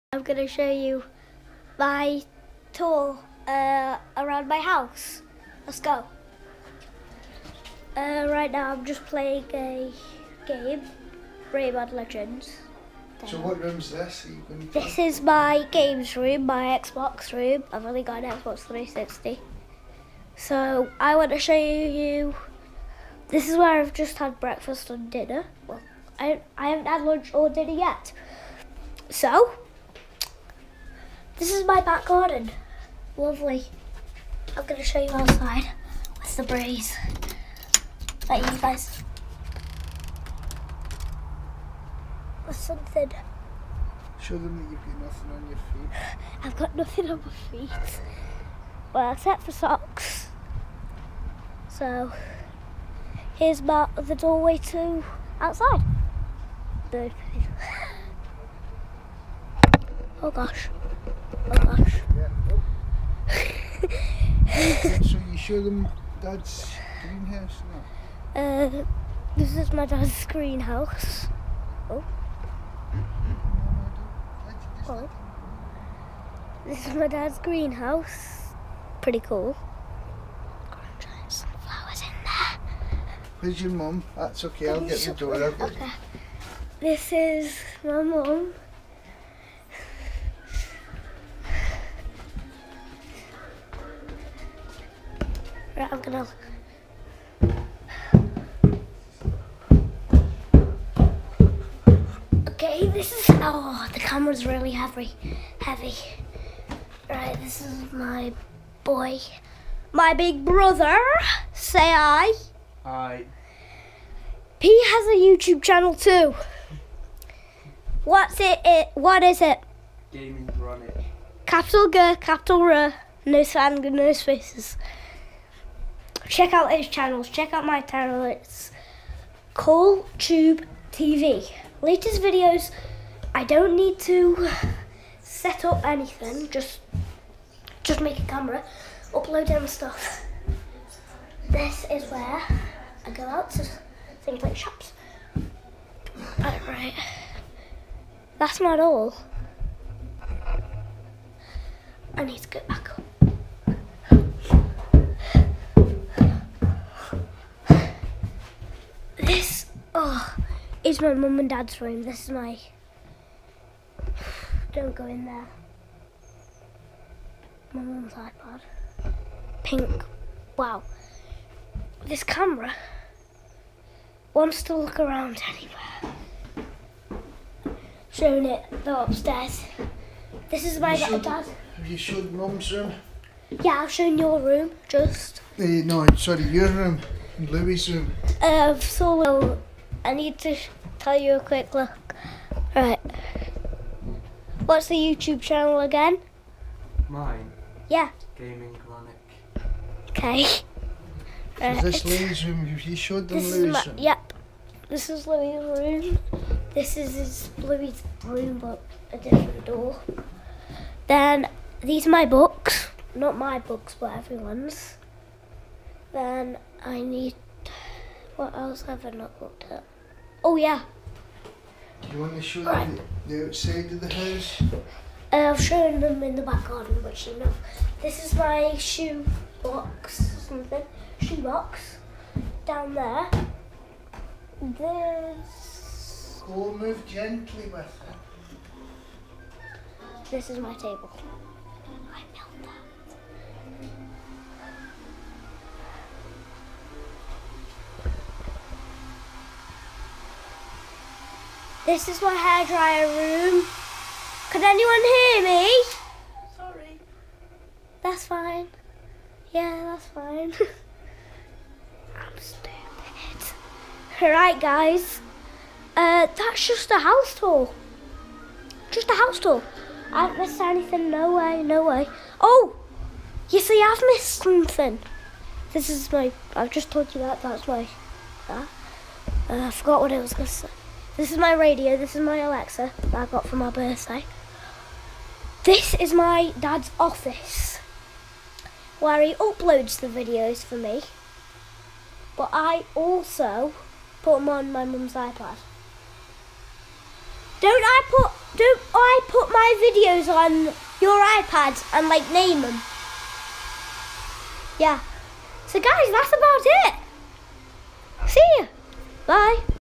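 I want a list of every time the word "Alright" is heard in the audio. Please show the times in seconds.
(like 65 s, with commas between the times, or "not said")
146 s, 264 s.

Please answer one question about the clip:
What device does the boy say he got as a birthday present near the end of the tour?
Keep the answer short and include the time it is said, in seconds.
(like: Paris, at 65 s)
Alexa, at 282 s.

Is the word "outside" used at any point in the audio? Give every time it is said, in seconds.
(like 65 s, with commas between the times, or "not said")
35 s, 55 s, 223 s.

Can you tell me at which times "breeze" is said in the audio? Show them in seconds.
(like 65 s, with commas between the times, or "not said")
36 s.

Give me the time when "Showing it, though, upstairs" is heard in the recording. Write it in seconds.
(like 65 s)
178 s.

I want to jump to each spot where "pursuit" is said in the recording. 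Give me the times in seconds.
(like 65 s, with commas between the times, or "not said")
not said.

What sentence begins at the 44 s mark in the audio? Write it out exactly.
Show them that you've got nothing on your feet.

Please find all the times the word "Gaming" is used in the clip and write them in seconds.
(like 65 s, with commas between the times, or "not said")
120 s, 198 s.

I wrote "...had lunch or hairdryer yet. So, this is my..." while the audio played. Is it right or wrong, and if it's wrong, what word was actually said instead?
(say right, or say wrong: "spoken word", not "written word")
wrong: "dinner", not "hairdryer".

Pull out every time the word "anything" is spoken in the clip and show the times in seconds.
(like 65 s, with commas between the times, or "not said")
135 s, 270 s.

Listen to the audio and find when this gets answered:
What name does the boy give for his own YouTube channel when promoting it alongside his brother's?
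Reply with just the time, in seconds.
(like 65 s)
129 s.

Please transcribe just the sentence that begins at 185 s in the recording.
Uh, no, sorry, your room and Louis' room.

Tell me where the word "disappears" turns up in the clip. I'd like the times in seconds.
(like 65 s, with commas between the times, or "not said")
not said.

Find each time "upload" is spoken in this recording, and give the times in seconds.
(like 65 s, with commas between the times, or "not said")
139 s, 289 s.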